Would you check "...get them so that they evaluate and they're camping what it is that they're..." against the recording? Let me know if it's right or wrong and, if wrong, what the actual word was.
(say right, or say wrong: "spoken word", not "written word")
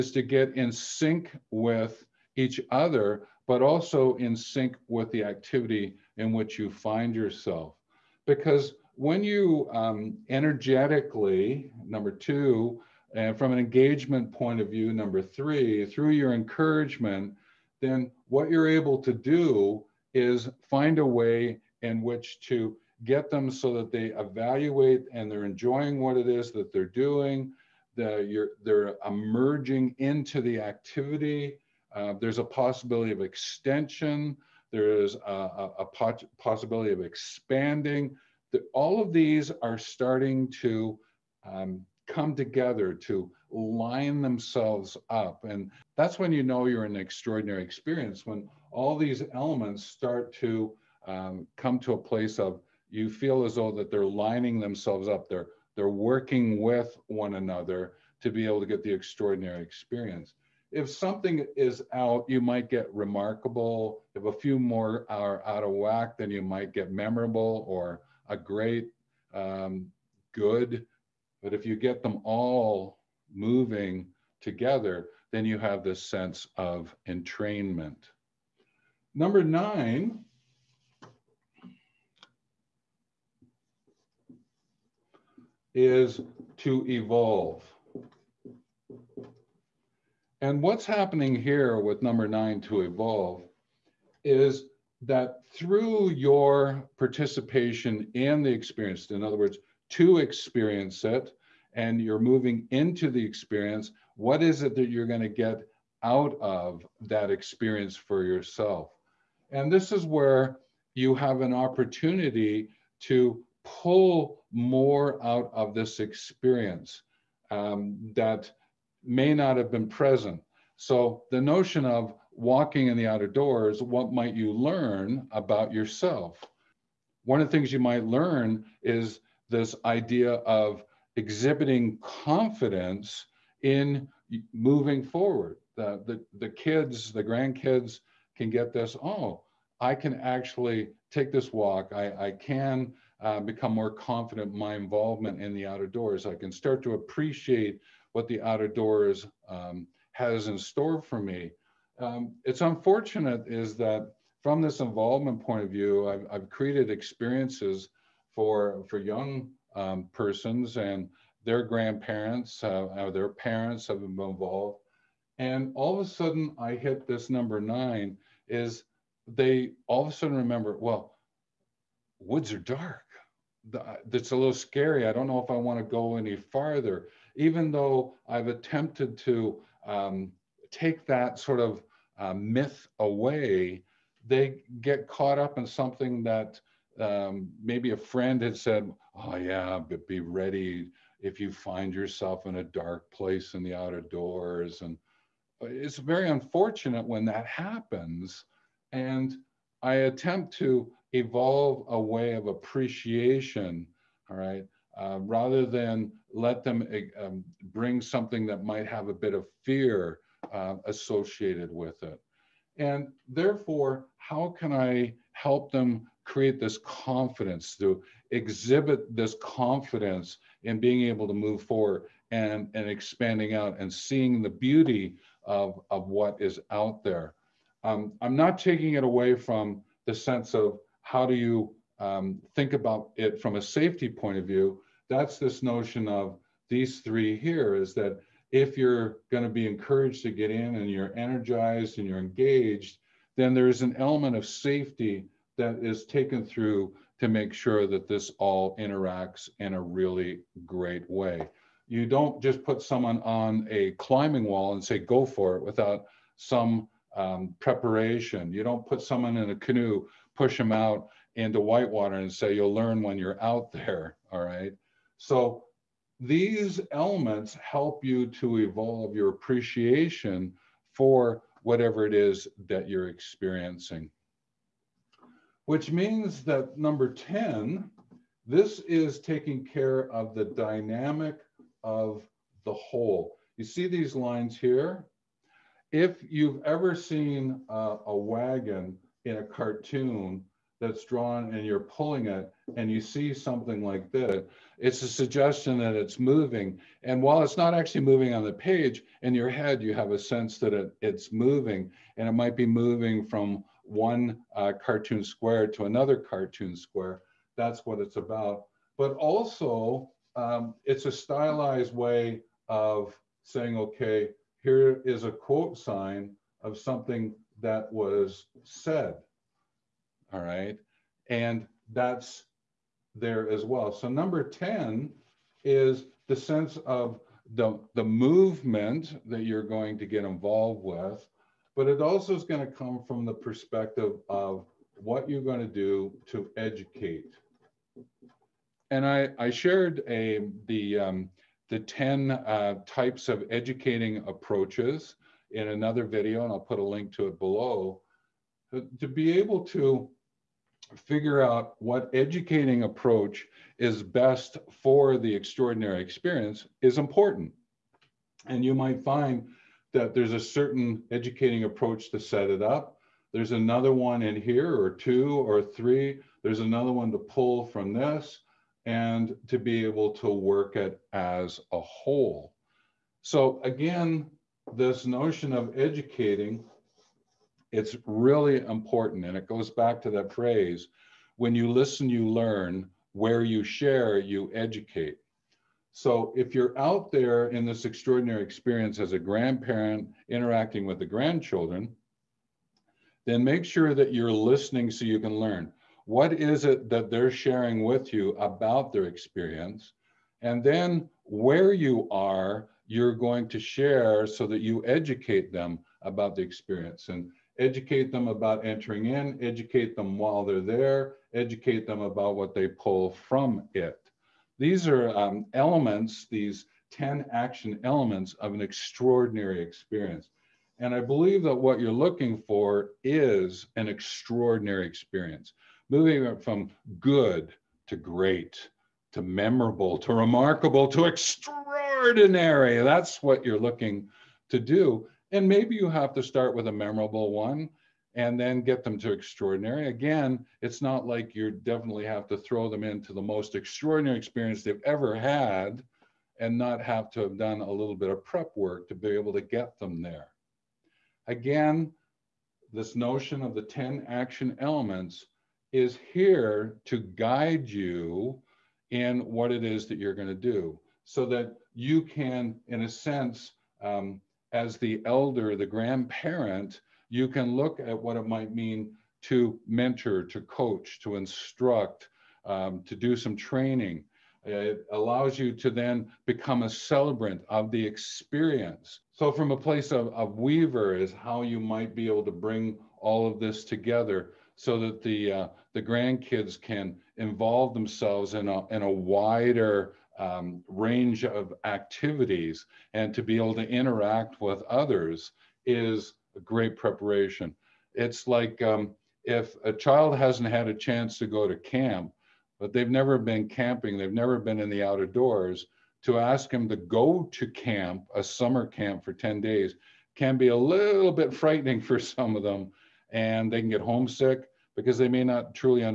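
wrong: "enjoying", not "camping".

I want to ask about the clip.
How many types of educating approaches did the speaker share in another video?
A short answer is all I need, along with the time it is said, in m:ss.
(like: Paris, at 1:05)
10, at 5:41.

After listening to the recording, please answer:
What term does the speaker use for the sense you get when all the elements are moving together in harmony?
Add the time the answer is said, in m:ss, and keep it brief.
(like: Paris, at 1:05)
Entrainment, at 1:17.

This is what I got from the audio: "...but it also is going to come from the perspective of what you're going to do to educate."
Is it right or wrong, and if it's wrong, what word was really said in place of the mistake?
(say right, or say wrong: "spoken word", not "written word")
right.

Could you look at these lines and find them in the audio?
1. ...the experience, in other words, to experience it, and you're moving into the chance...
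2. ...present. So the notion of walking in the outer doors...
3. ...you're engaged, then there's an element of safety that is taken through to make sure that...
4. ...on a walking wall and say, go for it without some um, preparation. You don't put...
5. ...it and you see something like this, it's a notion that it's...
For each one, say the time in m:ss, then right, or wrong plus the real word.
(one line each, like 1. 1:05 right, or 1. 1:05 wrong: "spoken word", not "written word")
1. 1:38 wrong: "experience", not "chance"
2. 1:59 right
3. 4:02 right
4. 4:13 wrong: "climbing", not "walking"
5. 4:52 wrong: "suggestion", not "notion".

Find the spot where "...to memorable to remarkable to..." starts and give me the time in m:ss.
7:09.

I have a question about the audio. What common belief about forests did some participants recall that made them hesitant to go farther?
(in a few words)
Woods are dark.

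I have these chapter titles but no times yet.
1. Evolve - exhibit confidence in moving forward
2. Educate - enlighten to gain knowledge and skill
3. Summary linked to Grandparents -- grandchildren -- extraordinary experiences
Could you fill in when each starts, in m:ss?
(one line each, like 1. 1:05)
1. 1:17
2. 4:35
3. 7:29.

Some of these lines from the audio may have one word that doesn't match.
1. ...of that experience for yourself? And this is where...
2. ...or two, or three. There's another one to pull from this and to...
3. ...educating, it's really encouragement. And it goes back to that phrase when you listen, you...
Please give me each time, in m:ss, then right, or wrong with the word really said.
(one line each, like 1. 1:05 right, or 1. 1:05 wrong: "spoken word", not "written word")
1. 1:46 right
2. 6:04 right
3. 6:15 wrong: "important", not "encouragement".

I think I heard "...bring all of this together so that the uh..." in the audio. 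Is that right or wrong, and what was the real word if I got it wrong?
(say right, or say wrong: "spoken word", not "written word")
right.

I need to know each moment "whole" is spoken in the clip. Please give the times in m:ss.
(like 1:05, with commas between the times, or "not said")
4:42, 6:11.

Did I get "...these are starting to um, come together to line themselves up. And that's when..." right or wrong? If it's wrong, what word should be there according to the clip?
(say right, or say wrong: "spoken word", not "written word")
right.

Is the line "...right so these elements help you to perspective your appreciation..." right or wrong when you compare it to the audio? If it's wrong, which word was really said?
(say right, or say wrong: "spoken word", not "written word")
wrong: "evolve", not "perspective".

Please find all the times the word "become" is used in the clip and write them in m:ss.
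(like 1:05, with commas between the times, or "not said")
2:23, 7:56.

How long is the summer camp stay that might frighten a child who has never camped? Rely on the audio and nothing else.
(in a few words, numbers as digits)
10 days.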